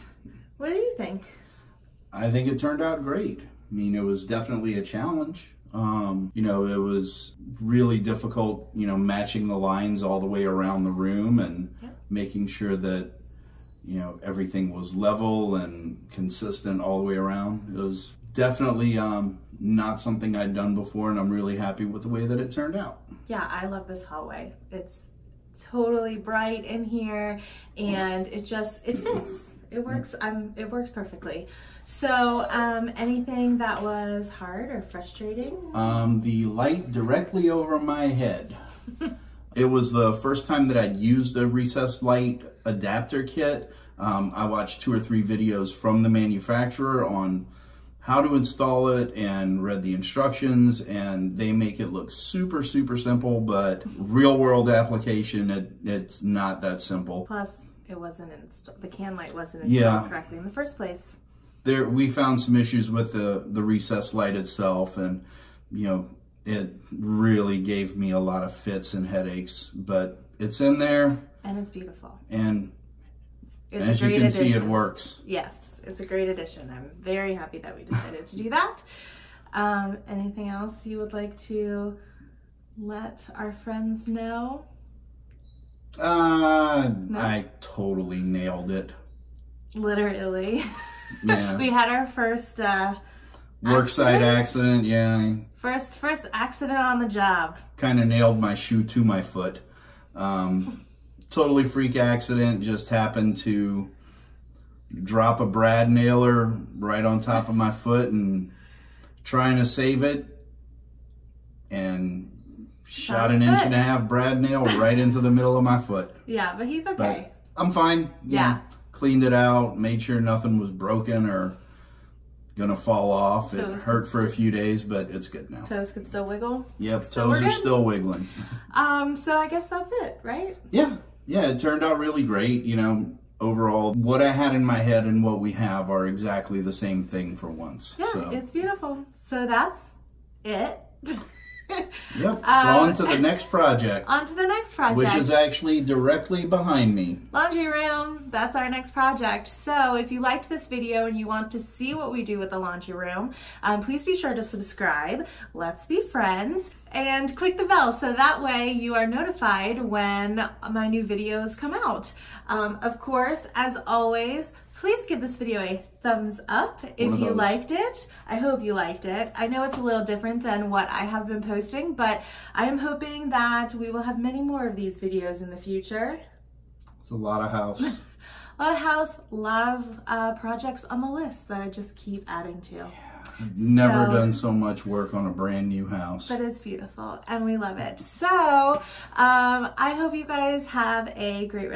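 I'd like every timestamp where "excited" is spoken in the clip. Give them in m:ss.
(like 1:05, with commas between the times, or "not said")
not said.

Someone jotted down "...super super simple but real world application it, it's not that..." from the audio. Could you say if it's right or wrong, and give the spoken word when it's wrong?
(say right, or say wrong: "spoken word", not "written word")
right.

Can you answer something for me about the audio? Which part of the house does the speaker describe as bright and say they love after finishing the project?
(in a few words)
hallway.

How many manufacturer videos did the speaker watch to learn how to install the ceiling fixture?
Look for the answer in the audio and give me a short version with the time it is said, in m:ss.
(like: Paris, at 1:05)
2 or 3, at 0:44.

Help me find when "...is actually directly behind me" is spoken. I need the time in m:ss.
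2:25.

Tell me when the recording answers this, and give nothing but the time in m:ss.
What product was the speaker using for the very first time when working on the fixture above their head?
0:41.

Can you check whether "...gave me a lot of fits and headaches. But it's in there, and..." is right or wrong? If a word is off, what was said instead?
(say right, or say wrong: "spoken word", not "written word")
right.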